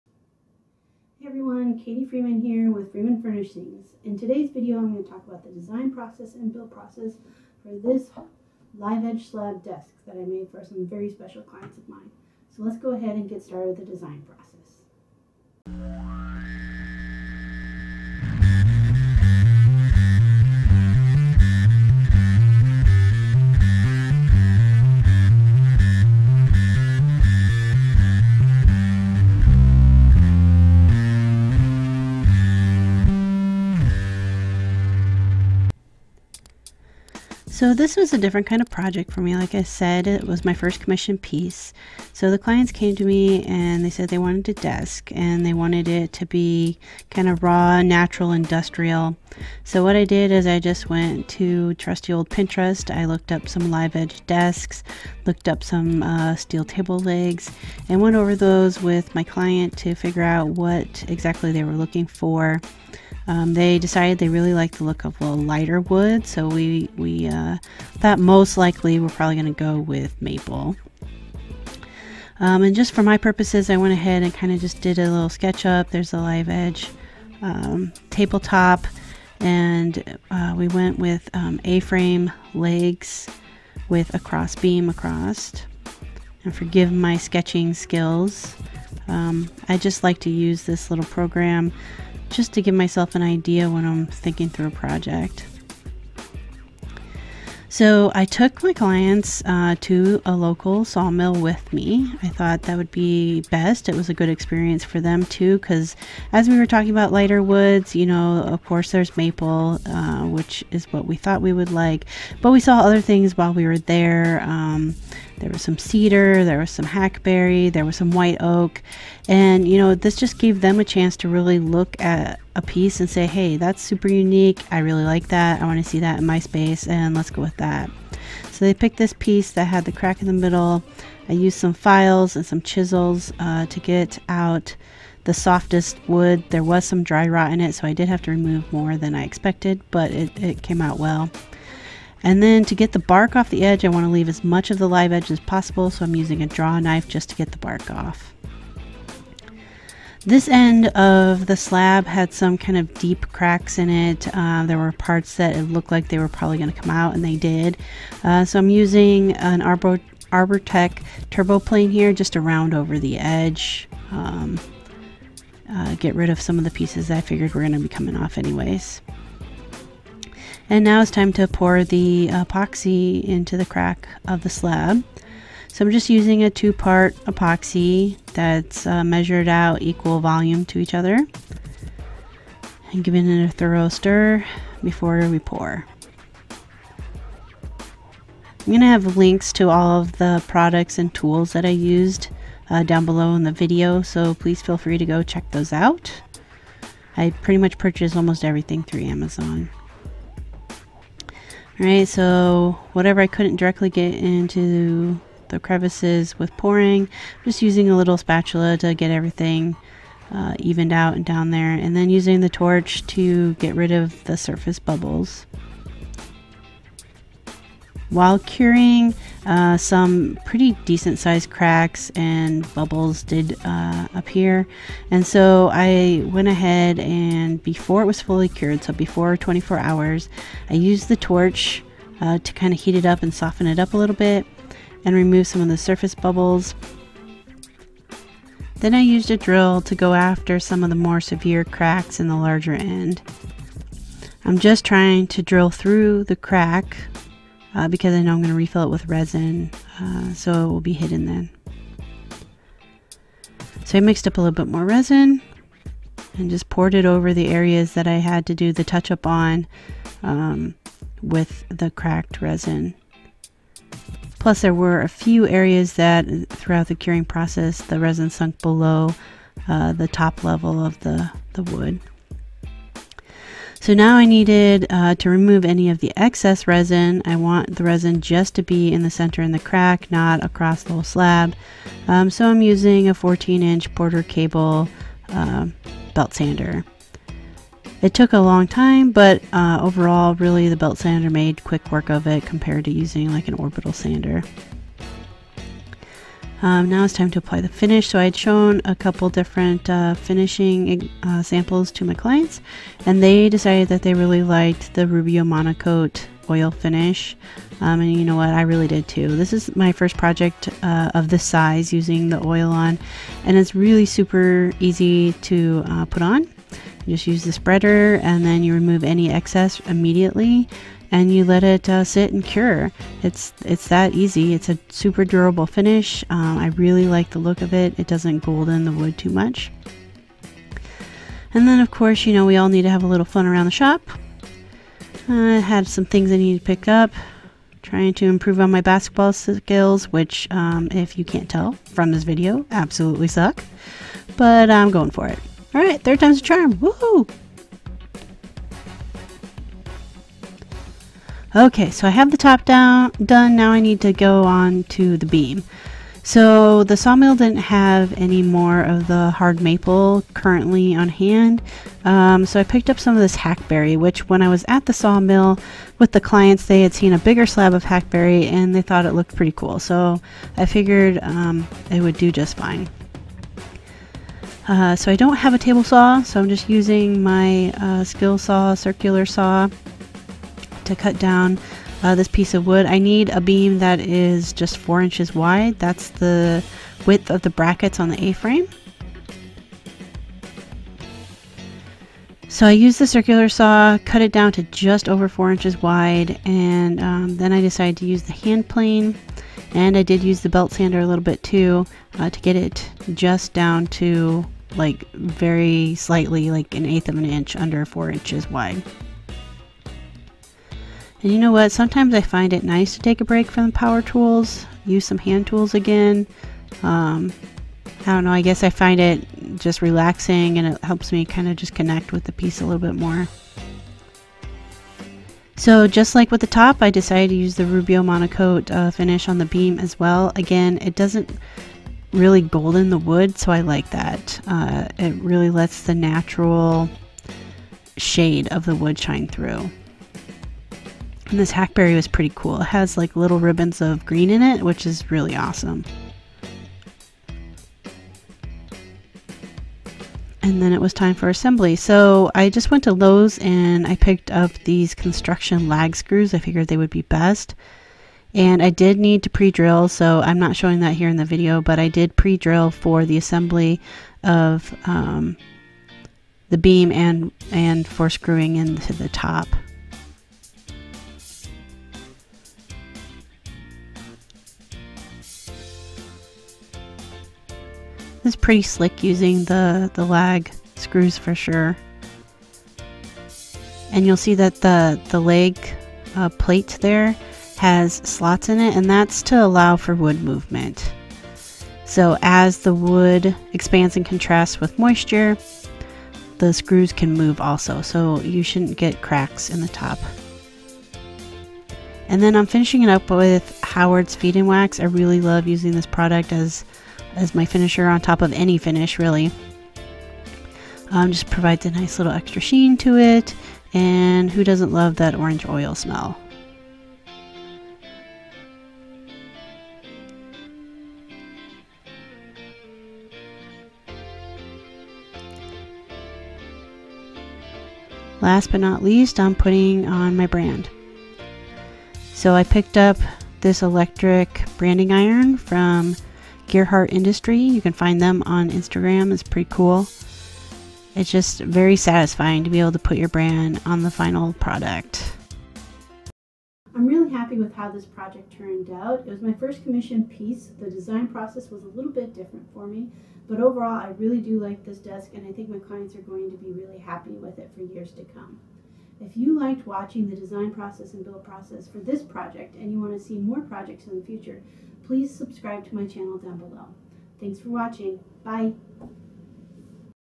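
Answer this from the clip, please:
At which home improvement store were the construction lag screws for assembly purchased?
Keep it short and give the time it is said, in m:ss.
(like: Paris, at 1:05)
Lowe's, at 7:32.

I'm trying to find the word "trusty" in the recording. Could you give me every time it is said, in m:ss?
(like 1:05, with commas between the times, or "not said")
0:51.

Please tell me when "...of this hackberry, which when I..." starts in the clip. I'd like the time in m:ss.
6:03.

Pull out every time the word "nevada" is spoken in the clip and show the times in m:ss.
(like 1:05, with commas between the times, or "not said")
not said.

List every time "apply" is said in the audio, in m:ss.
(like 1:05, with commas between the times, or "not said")
4:57.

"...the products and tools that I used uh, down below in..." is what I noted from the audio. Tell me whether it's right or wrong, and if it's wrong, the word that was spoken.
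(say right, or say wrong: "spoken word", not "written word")
right.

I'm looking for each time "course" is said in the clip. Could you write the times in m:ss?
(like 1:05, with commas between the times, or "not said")
1:48, 5:31.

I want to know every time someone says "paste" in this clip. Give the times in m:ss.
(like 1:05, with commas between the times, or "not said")
not said.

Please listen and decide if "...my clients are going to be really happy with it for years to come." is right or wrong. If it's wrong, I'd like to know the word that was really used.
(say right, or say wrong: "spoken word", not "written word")
right.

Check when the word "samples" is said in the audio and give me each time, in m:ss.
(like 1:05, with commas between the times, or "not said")
5:01.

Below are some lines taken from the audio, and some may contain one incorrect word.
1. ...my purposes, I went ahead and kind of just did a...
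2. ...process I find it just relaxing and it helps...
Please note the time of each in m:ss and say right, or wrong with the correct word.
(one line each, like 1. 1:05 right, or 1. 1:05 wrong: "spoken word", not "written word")
1. 1:13 right
2. 6:58 wrong: "guess", not "process".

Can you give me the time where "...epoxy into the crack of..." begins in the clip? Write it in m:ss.
2:52.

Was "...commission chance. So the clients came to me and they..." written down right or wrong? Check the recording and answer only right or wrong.
wrong.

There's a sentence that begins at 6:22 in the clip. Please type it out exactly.
I need a beam that is just four inches wide.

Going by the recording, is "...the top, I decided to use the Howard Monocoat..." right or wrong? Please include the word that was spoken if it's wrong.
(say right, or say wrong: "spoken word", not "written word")
wrong: "Rubio", not "Howard".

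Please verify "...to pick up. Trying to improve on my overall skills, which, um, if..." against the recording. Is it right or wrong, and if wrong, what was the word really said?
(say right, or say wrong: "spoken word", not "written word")
wrong: "basketball", not "overall".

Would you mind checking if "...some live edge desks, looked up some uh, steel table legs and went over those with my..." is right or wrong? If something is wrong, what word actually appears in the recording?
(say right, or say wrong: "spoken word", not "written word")
right.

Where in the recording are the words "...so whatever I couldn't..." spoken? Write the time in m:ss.
3:22.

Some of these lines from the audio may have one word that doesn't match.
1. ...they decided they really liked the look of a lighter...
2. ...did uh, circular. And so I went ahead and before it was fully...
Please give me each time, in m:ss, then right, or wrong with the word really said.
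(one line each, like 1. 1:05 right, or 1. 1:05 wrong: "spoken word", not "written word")
1. 1:03 right
2. 3:43 wrong: "appear", not "circular".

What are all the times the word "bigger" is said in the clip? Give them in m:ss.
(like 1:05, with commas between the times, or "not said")
6:07.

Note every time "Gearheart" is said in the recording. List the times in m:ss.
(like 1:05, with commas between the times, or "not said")
8:56.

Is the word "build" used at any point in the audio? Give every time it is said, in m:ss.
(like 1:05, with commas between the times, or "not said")
0:06, 9:21.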